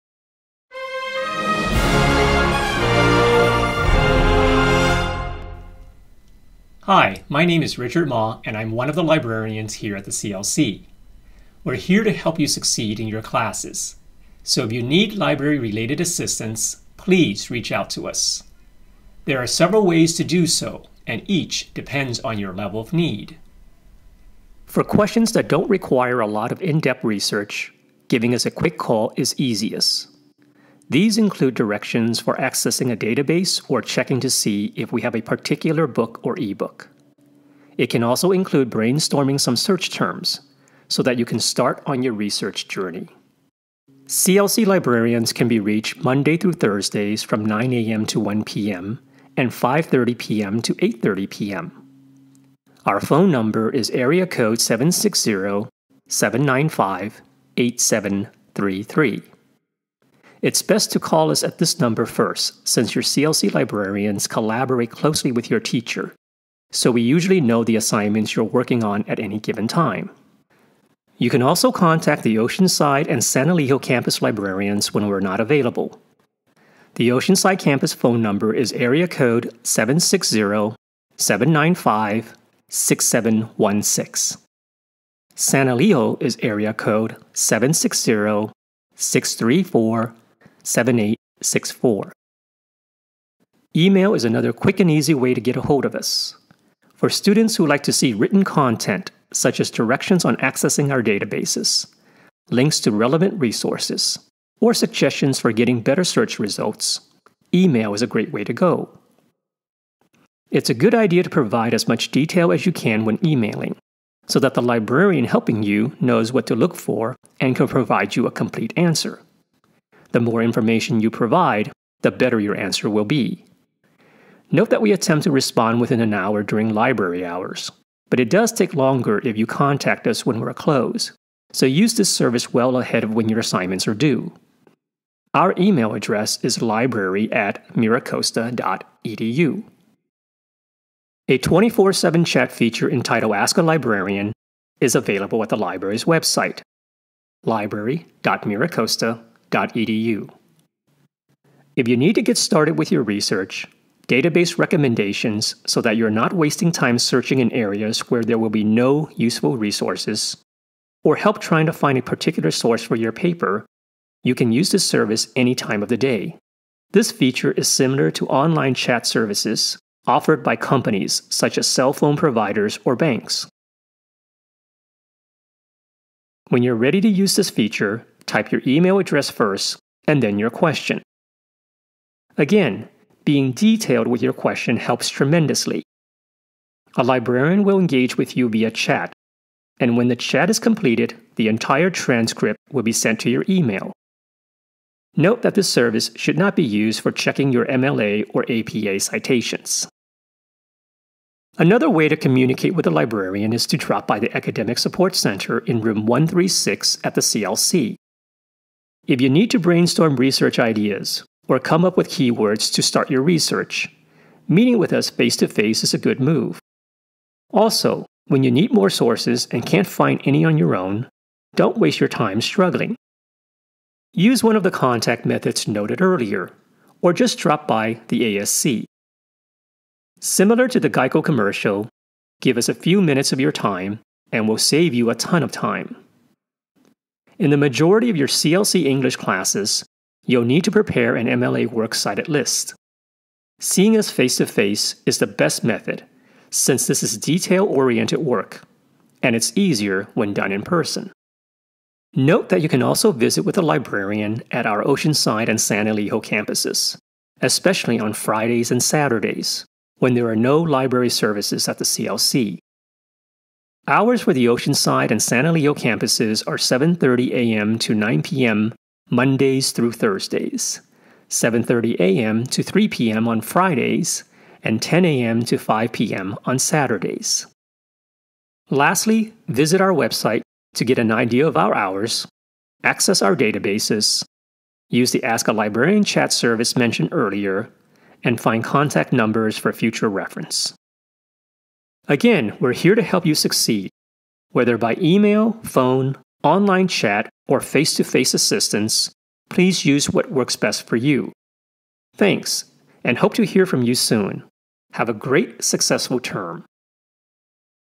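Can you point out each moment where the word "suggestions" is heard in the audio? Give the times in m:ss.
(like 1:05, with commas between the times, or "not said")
1:44.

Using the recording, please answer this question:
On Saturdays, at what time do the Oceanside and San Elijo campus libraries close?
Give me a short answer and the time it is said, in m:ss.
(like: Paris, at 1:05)
5 p.m., at 4:35.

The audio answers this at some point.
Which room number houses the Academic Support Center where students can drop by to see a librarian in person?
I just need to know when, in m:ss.
3:26.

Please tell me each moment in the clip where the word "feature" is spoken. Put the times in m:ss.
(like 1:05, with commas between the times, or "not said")
2:22, 2:47, 2:57.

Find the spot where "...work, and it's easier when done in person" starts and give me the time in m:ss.
4:08.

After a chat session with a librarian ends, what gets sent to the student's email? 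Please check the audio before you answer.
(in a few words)
The entire transcript.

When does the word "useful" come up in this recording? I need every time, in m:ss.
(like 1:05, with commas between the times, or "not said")
2:39.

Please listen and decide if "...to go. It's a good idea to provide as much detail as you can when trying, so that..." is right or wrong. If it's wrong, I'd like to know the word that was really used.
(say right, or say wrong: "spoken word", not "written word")
wrong: "emailing", not "trying".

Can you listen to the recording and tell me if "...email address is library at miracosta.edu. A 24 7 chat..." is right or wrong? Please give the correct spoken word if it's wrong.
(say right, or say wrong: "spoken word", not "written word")
right.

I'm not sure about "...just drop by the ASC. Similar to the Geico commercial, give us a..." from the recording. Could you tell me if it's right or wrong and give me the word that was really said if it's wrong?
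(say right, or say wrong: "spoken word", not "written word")
right.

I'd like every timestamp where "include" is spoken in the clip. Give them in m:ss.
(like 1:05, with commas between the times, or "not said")
0:31, 0:38.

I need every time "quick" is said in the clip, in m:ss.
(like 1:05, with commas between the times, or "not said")
0:28, 1:34.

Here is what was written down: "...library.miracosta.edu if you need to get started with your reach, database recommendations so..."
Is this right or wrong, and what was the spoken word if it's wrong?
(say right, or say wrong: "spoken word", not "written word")
wrong: "research", not "reach".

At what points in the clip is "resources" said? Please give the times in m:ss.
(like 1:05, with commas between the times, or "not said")
1:43, 2:39.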